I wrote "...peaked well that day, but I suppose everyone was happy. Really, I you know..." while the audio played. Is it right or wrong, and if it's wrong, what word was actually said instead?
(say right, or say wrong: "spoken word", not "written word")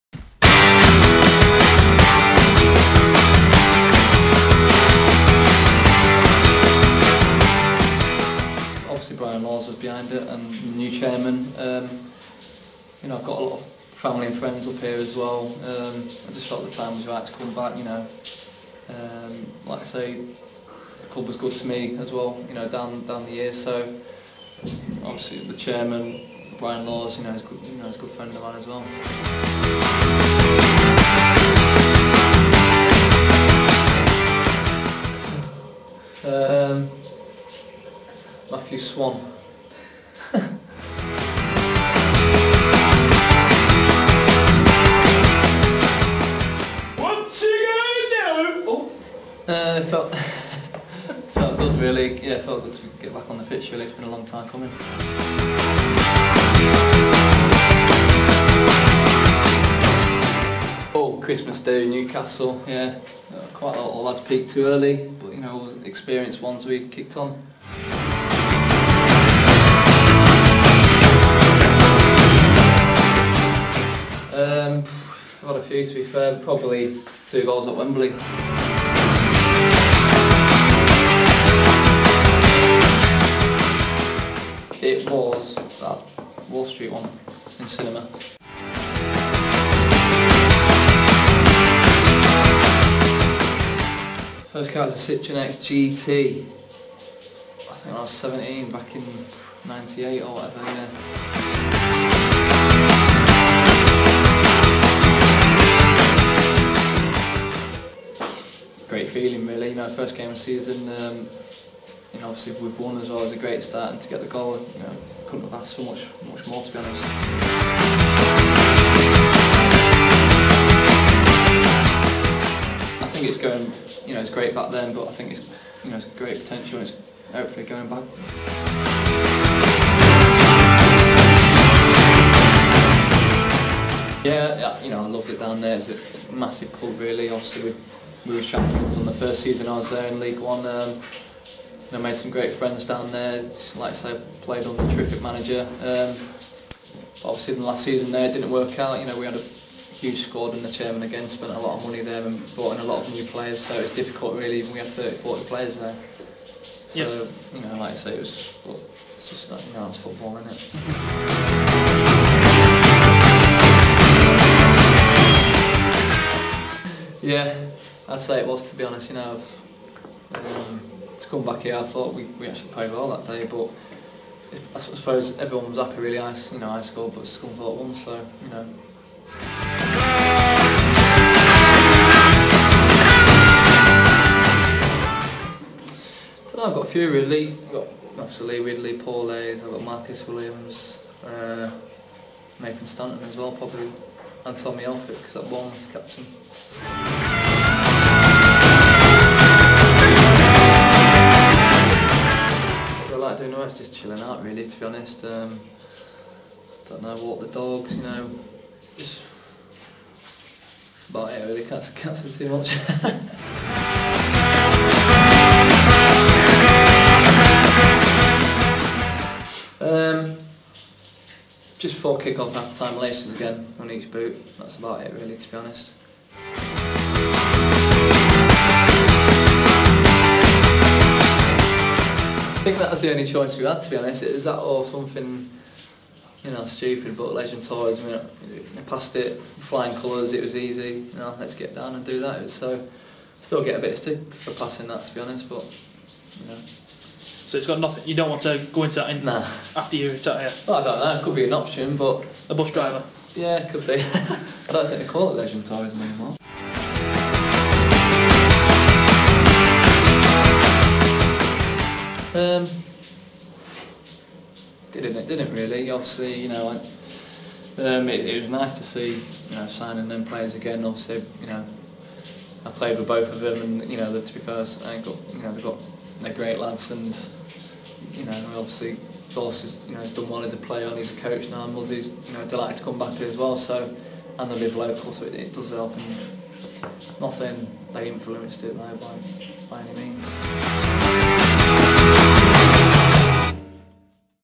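wrong: "played", not "peaked".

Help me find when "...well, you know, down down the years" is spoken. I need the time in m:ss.
0:22.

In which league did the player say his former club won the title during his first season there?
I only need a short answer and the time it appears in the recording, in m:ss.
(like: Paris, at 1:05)
League One, at 2:20.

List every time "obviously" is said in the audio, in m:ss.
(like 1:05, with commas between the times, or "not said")
0:25, 1:52, 2:17, 2:27, 3:08, 4:25, 4:30, 4:38.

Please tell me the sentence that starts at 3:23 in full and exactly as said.
I do know it's just chilling out really, to be honest.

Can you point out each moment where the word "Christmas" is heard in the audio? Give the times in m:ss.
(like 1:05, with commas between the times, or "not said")
1:01.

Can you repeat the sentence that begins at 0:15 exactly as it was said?
Um, I just felt the time was right to come back, you know.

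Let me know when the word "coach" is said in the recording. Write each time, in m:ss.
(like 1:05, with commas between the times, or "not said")
4:41.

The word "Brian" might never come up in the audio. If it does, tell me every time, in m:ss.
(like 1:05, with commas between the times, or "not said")
0:09, 0:26.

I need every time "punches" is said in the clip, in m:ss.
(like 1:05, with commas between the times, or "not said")
not said.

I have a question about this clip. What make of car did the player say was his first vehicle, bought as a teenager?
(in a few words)
Citroen.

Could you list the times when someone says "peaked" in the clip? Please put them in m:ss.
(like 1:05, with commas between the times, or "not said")
1:04.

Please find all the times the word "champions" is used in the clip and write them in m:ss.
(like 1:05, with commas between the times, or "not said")
2:18.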